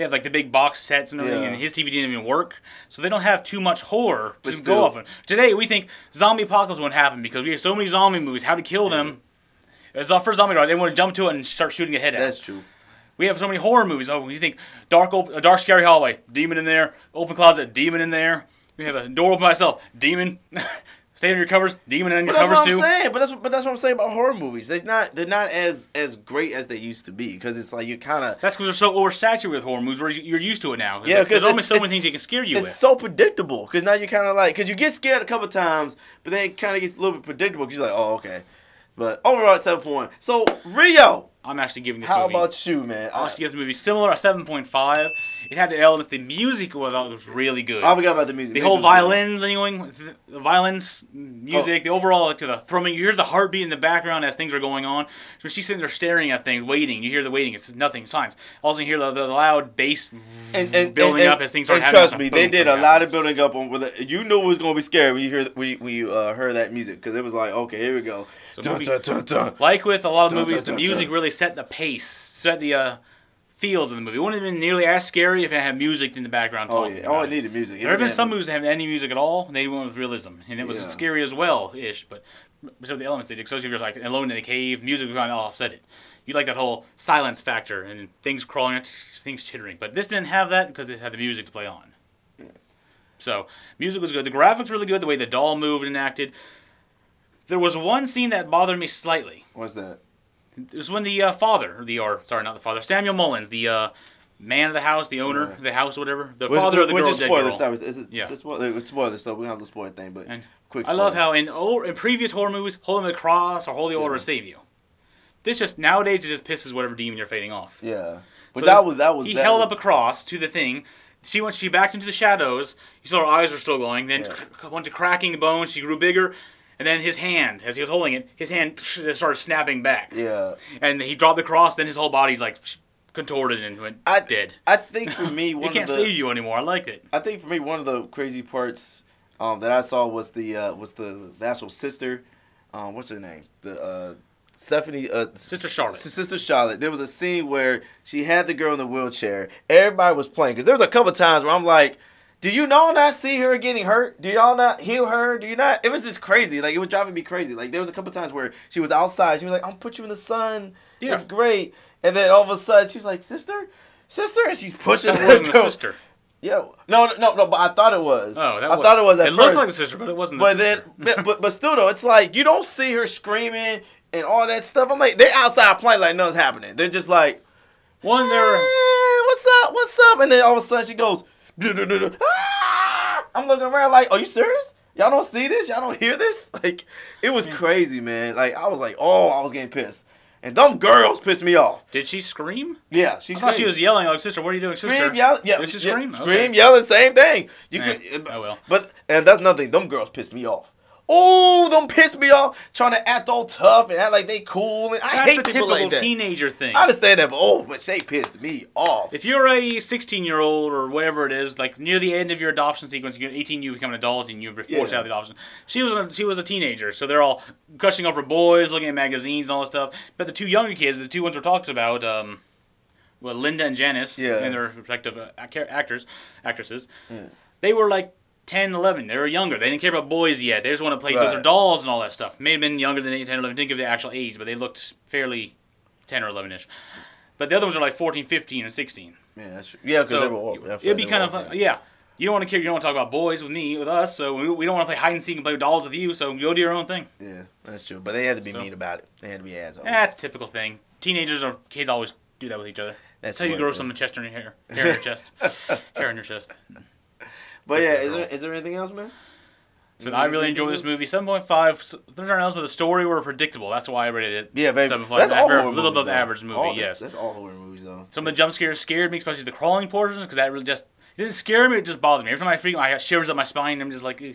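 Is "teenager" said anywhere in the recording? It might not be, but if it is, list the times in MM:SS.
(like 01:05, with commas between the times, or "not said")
03:25, 03:36, 04:10.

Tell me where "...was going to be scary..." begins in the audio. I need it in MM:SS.
01:04.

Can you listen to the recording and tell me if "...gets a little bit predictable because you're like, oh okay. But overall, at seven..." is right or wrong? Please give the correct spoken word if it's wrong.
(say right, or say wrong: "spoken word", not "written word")
right.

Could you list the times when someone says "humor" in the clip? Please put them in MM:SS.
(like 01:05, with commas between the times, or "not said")
not said.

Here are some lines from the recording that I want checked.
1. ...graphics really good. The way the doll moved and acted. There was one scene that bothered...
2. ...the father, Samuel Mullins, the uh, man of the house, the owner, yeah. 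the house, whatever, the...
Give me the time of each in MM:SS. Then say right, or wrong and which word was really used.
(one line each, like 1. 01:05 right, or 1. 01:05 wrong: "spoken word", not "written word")
1. 01:34 right
2. 01:42 right.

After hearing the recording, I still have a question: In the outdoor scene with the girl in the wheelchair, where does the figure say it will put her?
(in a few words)
In the sun.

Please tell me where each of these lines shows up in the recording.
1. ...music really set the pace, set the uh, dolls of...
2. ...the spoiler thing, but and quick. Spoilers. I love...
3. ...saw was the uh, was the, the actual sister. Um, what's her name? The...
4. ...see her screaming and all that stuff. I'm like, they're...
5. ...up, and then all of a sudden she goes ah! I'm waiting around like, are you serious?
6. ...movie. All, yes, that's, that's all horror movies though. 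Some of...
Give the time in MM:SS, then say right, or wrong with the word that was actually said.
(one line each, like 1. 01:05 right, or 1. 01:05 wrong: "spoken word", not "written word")
1. 01:10 wrong: "feels", not "dolls"
2. 01:49 right
3. 02:19 right
4. 02:52 right
5. 03:00 wrong: "looking", not "waiting"
6. 04:26 right.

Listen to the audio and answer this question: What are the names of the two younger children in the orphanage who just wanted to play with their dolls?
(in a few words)
Linda and Janice.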